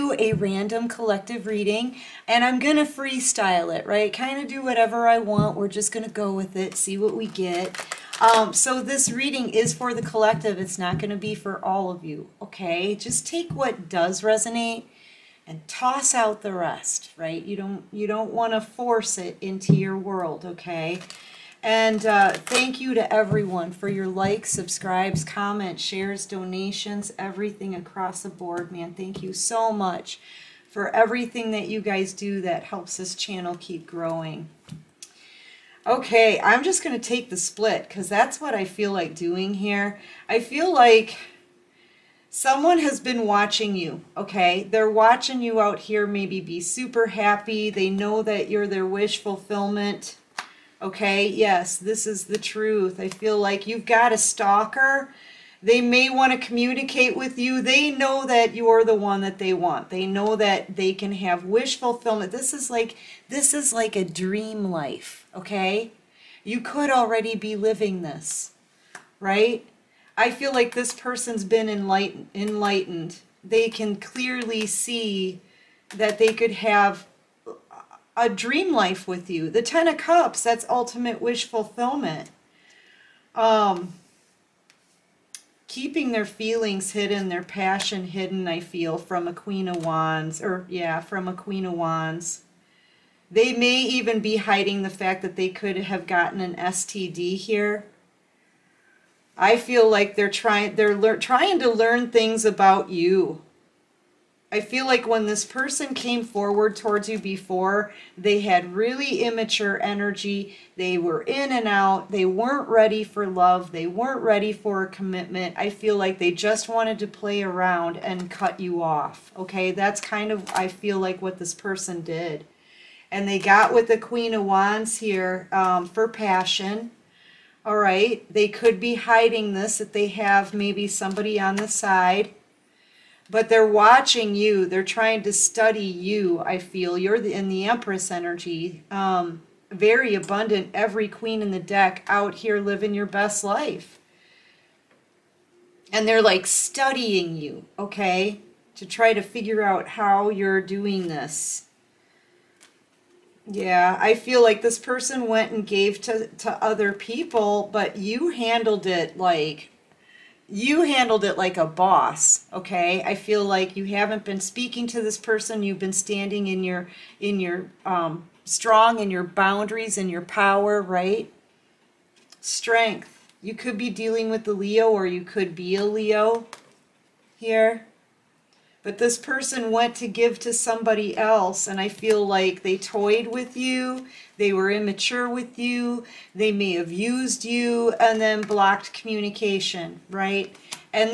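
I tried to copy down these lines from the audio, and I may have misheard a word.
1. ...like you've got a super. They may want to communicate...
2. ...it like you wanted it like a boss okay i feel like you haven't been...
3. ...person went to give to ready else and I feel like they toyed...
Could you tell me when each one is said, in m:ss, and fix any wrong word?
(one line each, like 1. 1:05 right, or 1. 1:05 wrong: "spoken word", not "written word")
1. 0:53 wrong: "stalker", not "super"
2. 2:38 wrong: "handled", not "wanted"
3. 2:59 wrong: "somebody", not "ready".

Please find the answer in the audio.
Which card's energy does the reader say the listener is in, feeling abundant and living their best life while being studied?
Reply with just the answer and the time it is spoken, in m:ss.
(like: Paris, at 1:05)
The Empress, at 2:17.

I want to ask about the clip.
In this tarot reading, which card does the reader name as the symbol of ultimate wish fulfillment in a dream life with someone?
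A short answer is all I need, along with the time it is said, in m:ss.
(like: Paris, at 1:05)
Ten of Cups, at 1:19.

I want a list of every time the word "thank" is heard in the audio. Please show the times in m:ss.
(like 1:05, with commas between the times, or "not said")
0:22, 0:28.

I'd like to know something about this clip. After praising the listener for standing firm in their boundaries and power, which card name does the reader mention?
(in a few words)
Strength.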